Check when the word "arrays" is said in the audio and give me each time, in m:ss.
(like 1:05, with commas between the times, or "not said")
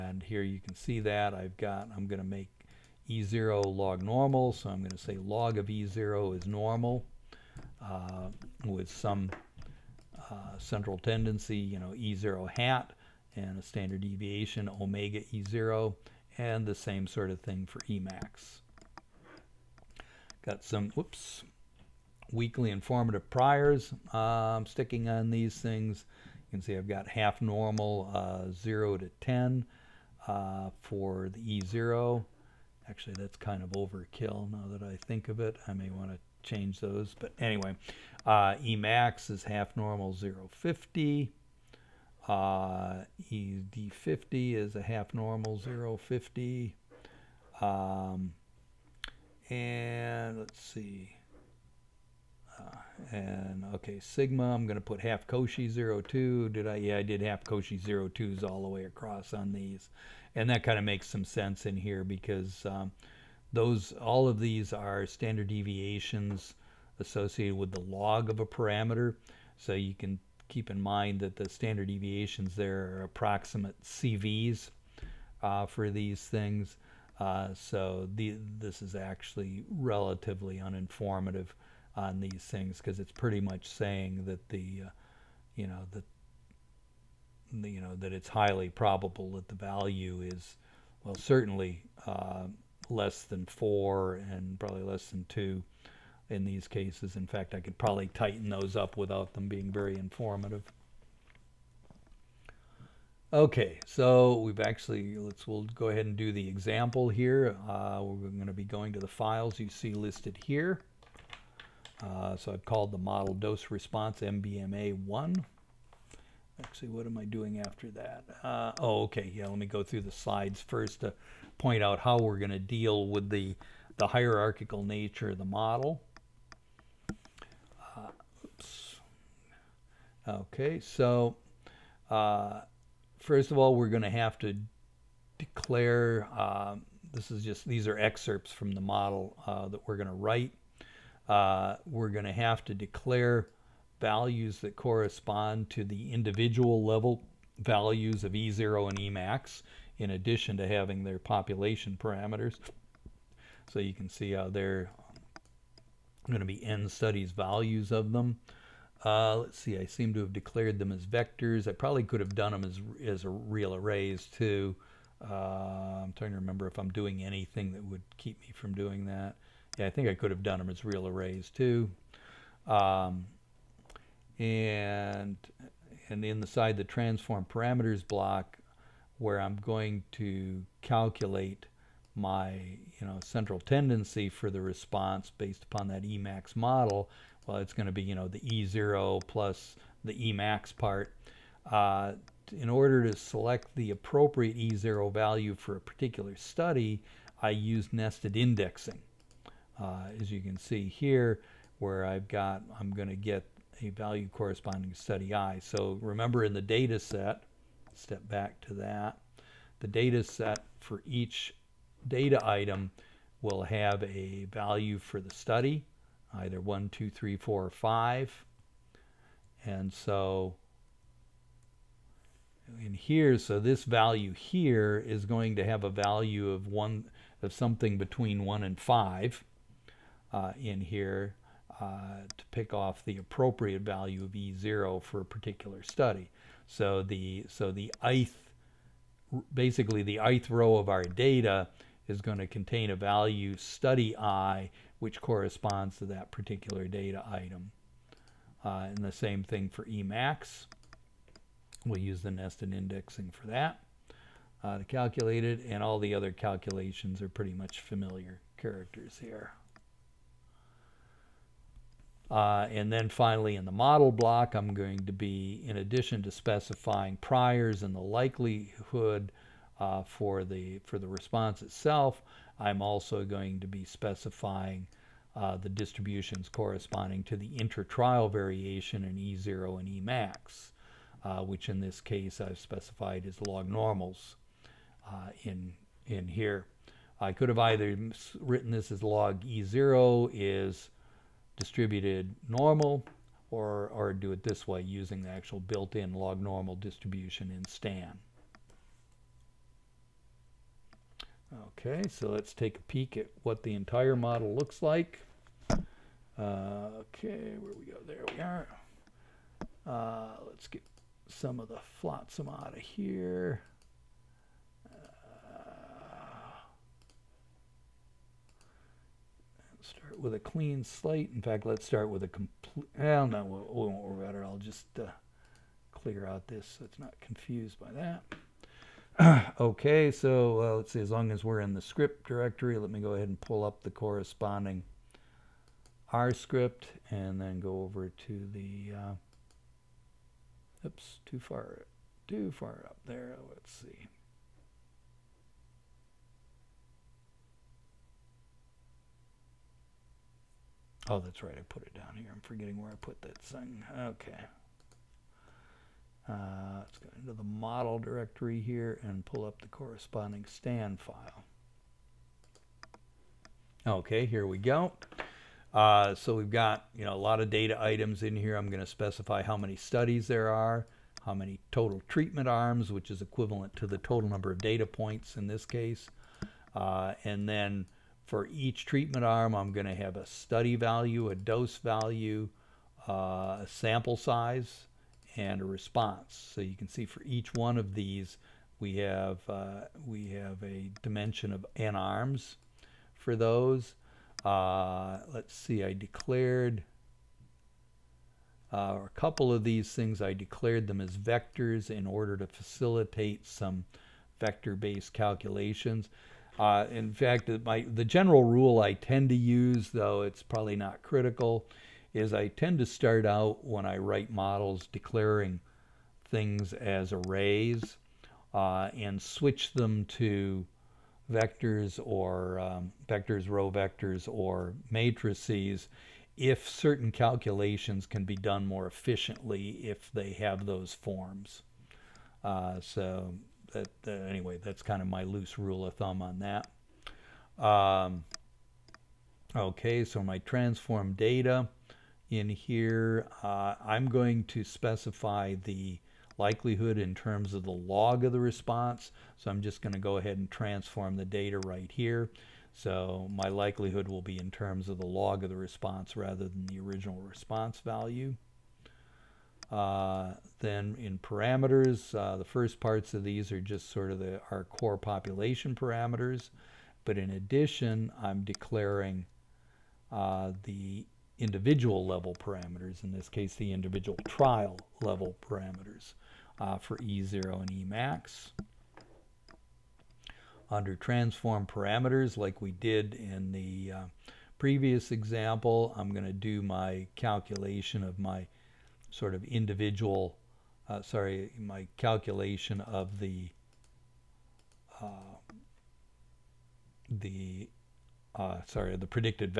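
2:43, 2:51, 6:57.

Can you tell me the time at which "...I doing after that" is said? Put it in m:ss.
1:57.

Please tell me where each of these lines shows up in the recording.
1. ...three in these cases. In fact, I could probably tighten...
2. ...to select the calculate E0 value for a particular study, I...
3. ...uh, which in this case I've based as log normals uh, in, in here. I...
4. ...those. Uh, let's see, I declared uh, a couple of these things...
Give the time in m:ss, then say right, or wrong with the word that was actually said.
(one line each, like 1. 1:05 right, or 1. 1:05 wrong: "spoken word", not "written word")
1. 1:35 wrong: "two", not "three"
2. 3:13 wrong: "appropriate", not "calculate"
3. 4:41 wrong: "specified", not "based"
4. 6:33 right.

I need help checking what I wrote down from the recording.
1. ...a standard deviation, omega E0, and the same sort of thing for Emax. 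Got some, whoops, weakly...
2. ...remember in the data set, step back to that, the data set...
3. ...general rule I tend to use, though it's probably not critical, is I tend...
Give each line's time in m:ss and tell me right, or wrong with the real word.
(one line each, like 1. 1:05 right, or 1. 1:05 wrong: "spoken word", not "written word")
1. 0:13 right
2. 3:25 right
3. 6:48 right.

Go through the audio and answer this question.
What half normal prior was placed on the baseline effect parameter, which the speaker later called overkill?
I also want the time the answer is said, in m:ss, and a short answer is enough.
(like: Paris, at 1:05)
half normal 0 to 10, at 0:27.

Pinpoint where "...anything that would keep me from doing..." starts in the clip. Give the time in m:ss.
2:47.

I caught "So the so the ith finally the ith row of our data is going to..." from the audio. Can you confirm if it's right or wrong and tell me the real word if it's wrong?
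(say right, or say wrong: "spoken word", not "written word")
wrong: "basically", not "finally".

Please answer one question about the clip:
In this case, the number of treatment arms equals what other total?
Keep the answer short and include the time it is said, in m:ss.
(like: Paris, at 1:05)
total number of data points, at 6:13.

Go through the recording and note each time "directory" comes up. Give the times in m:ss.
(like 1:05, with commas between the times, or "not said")
5:32, 5:57.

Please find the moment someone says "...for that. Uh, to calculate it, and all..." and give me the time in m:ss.
4:13.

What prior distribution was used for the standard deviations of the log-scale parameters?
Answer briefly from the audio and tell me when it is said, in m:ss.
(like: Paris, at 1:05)
half Cauchy 0, 2, at 0:54.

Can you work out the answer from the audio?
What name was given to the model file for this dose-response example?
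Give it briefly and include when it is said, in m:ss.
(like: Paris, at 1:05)
dose response MBMA1, at 1:53.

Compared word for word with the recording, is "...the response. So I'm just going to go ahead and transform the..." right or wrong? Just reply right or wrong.
right.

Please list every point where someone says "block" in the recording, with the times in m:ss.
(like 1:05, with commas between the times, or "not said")
2:58, 4:24.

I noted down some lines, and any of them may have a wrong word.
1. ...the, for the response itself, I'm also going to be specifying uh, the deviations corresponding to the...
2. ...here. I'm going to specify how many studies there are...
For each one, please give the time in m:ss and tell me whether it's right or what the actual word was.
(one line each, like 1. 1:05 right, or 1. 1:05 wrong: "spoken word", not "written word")
1. 4:30 wrong: "distributions", not "deviations"
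2. 6:08 right.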